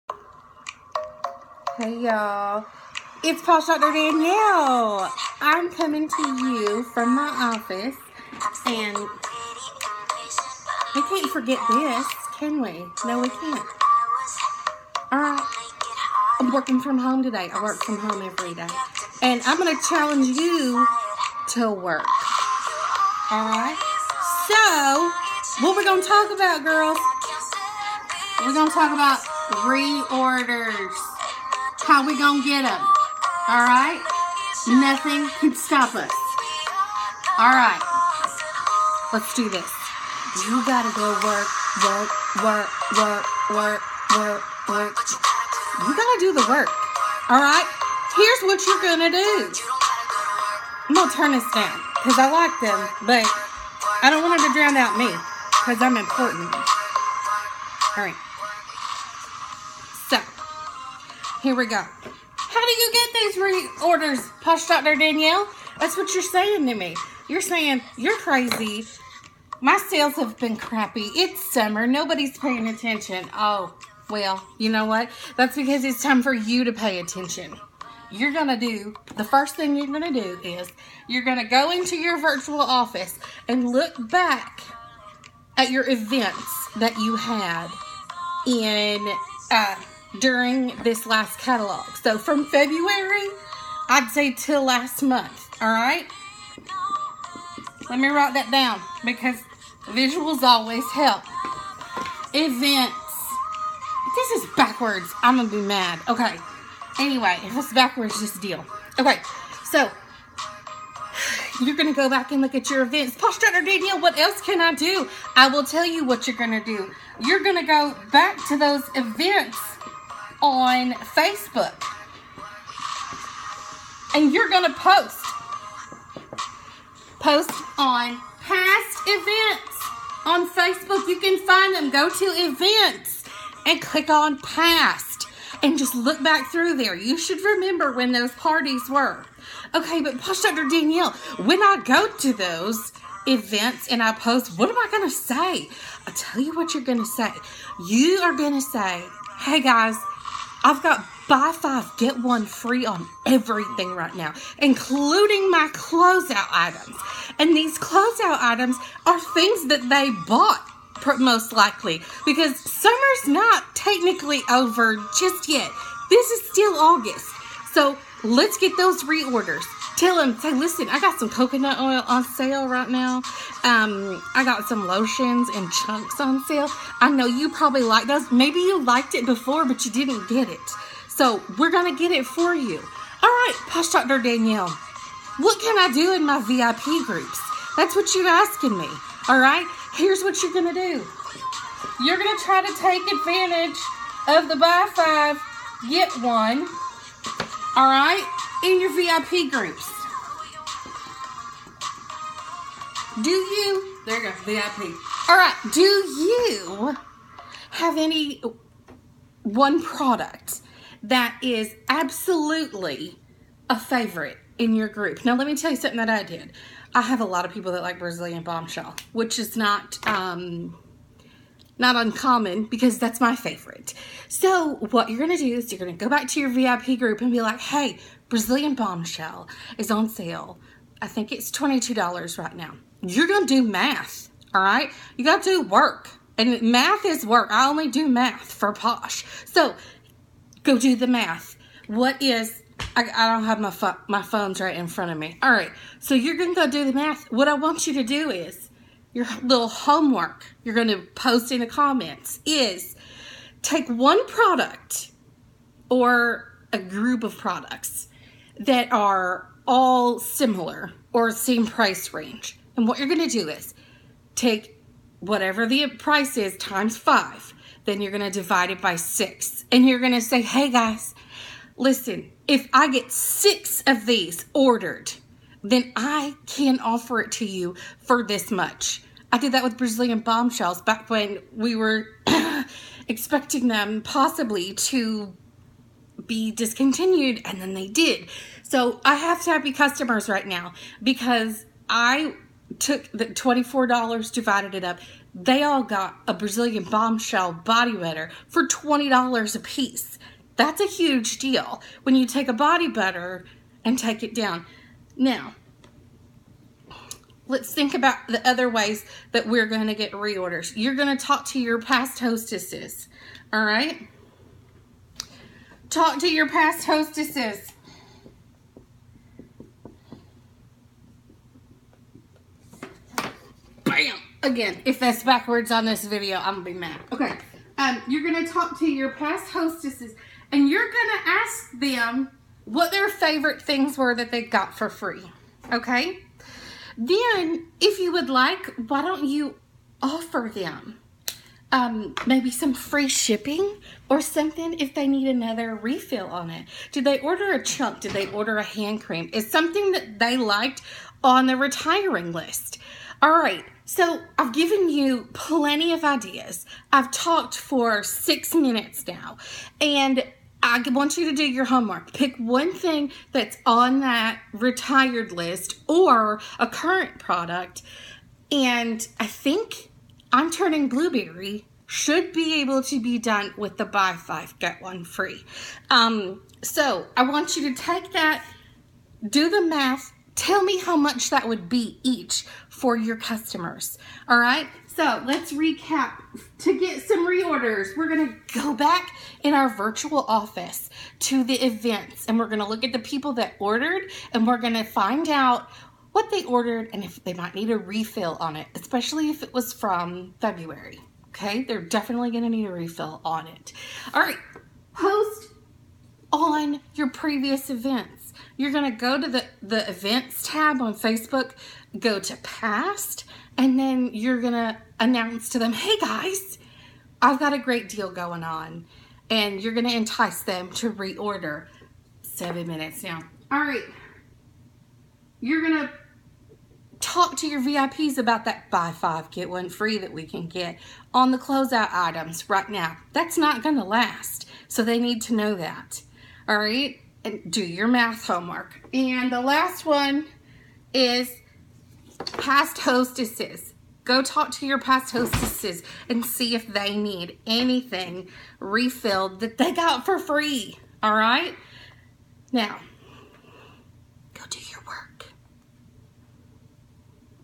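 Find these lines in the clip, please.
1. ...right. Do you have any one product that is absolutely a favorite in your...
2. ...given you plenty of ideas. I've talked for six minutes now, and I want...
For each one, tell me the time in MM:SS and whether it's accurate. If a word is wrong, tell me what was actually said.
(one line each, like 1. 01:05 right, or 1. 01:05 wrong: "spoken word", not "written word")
1. 03:25 right
2. 05:54 right.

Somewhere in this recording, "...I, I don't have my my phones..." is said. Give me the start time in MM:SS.
04:02.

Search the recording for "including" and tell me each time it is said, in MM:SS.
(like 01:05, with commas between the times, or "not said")
02:34.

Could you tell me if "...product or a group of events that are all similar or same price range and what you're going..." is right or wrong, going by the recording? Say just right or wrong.
wrong.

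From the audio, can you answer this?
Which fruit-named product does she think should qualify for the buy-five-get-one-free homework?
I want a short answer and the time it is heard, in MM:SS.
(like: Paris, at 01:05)
blueberry, at 06:10.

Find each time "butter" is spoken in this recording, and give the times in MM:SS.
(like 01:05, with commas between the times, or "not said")
04:57, 05:02.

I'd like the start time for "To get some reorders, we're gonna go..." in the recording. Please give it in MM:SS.
06:26.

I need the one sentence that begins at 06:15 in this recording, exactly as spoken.
Um, so I want you to take that, do the math, Tell me how much that would be each for your customers.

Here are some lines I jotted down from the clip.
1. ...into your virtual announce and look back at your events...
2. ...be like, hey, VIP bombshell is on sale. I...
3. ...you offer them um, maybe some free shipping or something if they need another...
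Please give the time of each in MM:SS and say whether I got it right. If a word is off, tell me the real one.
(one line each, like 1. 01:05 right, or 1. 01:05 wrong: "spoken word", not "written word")
1. 01:21 wrong: "office", not "announce"
2. 03:47 wrong: "Brazilian", not "VIP"
3. 05:39 right.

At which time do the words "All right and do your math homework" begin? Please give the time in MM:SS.
07:16.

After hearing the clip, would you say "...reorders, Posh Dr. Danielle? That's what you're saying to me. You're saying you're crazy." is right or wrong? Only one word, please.
right.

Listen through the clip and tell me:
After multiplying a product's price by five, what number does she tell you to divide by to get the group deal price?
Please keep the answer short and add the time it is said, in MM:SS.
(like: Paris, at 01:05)
6, at 04:27.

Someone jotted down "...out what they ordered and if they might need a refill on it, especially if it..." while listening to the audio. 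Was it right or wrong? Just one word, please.
right.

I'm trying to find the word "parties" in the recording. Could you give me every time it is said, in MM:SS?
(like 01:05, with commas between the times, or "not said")
02:18.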